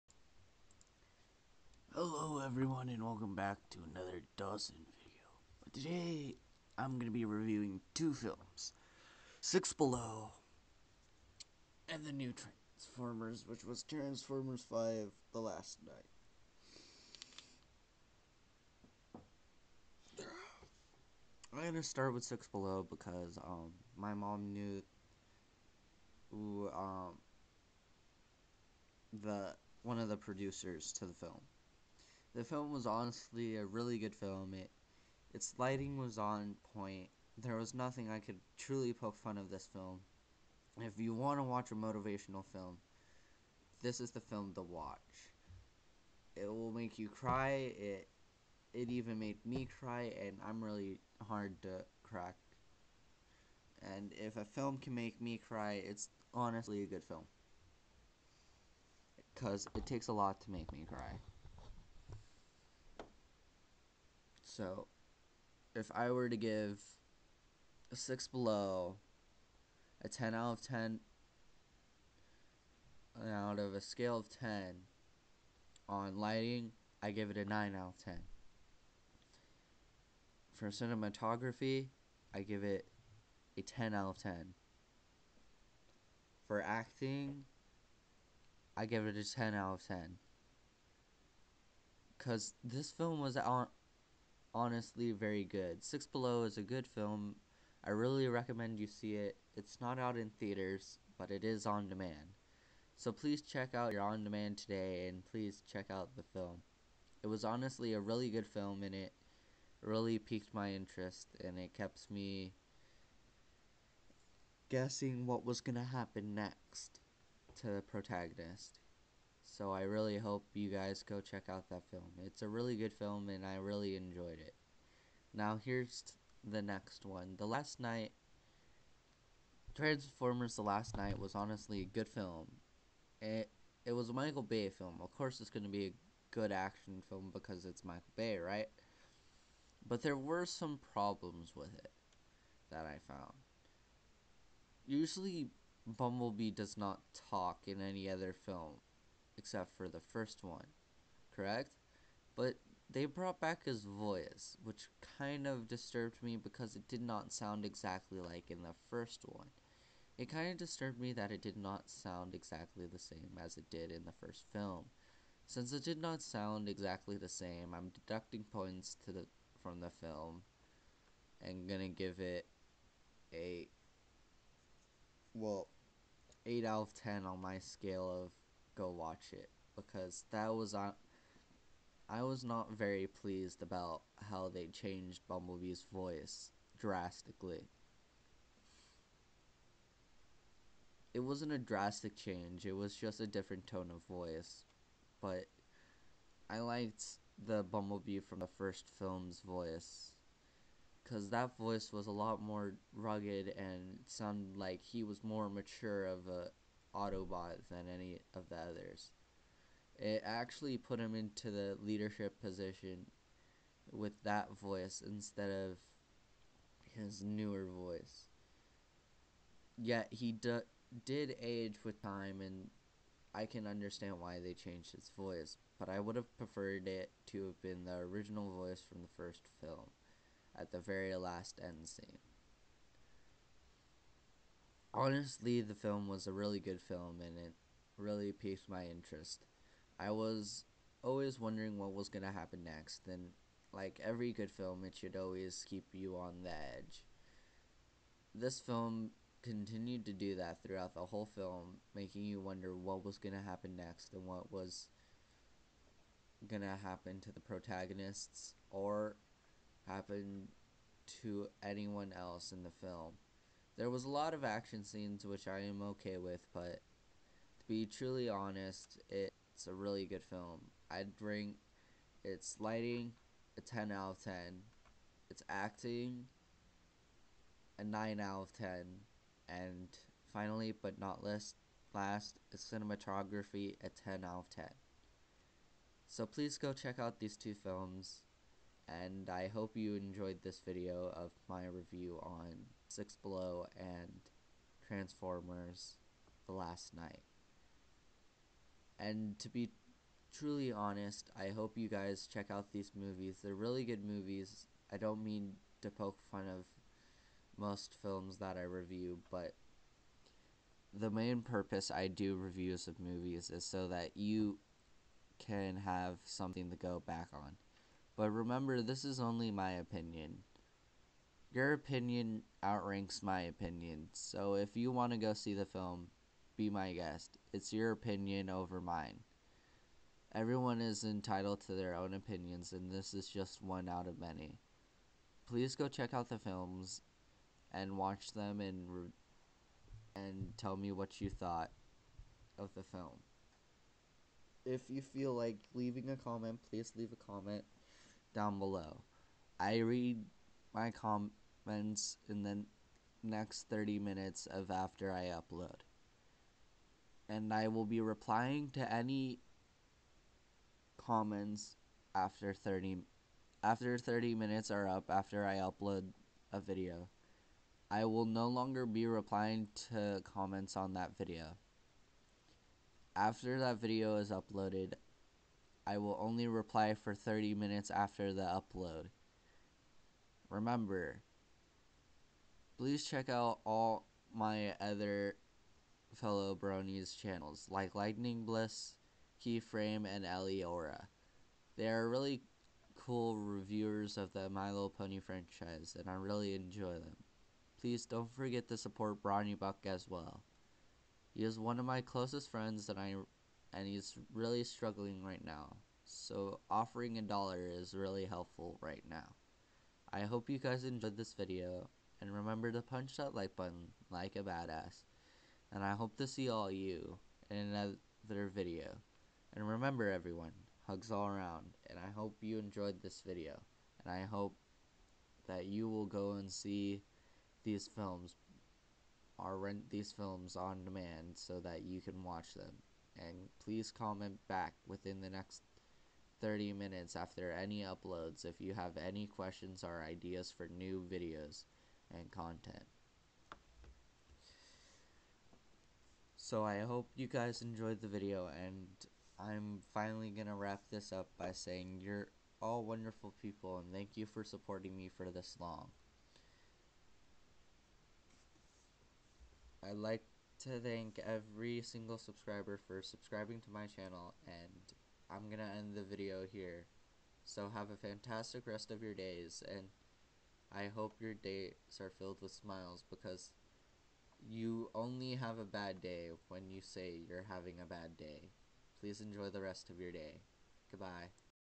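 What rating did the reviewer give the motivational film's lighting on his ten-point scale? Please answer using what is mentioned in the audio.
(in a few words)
9 out of 10.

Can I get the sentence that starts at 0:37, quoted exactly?
There was nothing I could truly poke fun of this film.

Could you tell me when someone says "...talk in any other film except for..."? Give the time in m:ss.
2:27.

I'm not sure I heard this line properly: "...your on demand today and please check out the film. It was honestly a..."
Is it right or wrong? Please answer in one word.
right.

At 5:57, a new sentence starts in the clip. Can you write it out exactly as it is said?
And I will be replying to any comments after 30 after 30 minutes are up after I upload a video.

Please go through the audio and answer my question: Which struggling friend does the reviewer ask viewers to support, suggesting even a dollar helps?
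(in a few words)
Brony Buck.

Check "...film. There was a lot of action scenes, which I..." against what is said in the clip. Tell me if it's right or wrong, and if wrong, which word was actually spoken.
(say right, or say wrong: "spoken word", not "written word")
right.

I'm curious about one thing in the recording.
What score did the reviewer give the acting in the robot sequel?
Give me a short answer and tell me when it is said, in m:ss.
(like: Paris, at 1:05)
9 out of 10, at 4:35.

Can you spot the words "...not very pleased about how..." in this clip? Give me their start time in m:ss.
3:02.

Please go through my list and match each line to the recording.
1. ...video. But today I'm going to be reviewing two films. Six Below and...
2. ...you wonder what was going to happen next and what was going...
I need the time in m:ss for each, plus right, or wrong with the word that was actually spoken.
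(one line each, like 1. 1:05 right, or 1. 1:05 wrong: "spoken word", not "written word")
1. 0:04 right
2. 4:12 right.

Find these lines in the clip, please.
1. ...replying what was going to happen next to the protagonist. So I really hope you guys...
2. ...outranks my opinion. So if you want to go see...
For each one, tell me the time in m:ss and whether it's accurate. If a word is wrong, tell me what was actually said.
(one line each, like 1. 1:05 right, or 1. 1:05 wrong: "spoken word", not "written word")
1. 1:54 wrong: "guessing", not "replying"
2. 5:22 right.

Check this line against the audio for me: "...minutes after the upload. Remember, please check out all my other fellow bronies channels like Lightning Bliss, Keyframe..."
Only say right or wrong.
right.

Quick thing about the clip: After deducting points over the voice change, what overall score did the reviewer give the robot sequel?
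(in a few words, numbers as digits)
8 out of 10.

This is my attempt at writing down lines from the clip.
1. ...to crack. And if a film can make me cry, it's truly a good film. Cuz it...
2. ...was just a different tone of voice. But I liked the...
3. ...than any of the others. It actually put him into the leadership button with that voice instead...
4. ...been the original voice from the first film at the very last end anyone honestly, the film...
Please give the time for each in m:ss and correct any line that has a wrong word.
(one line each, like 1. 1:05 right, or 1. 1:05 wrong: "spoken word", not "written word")
1. 0:51 wrong: "honestly", not "truly"
2. 3:12 right
3. 3:27 wrong: "position", not "button"
4. 3:47 wrong: "scene", not "anyone".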